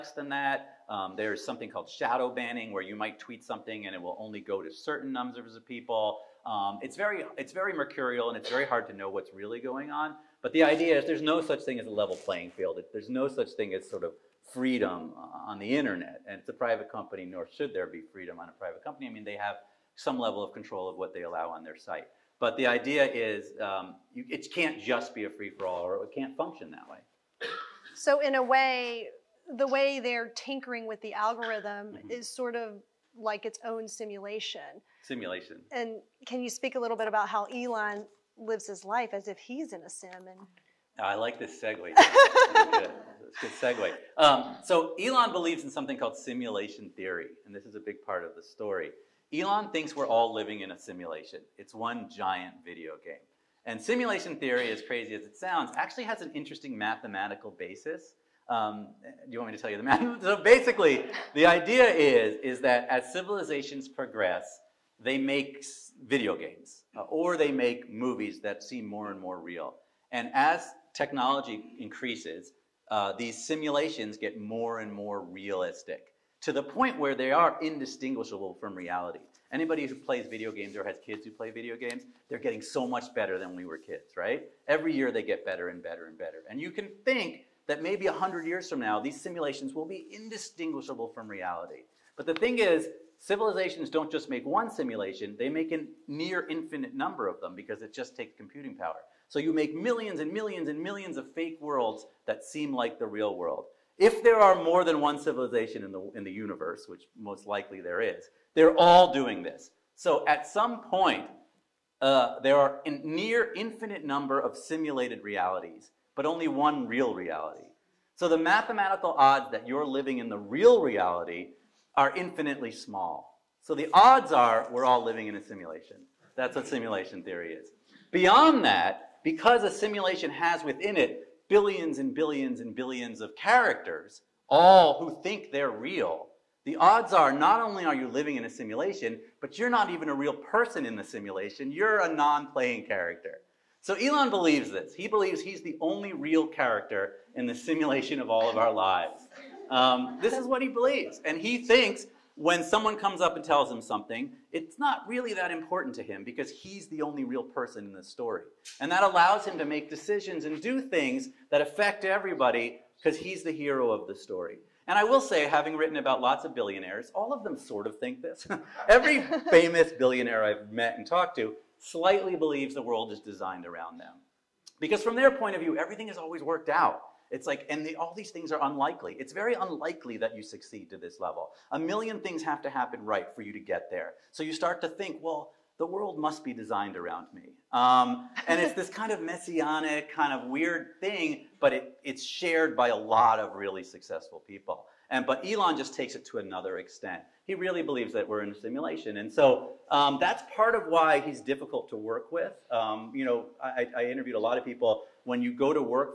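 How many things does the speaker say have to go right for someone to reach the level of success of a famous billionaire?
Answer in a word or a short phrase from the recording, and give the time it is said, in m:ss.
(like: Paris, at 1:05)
a million, at 3:01.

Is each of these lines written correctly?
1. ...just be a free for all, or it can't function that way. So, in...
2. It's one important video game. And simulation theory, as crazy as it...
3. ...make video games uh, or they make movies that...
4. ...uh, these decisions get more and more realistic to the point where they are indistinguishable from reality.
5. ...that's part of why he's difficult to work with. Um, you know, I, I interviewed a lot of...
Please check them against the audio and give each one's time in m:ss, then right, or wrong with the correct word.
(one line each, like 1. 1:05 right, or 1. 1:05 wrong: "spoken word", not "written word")
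1. 0:24 right
2. 0:51 wrong: "giant", not "important"
3. 1:05 right
4. 1:12 wrong: "simulations", not "decisions"
5. 3:20 right.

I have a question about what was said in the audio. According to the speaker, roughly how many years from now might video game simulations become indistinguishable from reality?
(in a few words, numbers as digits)
100 years.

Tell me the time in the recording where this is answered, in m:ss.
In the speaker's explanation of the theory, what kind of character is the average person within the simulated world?
2:22.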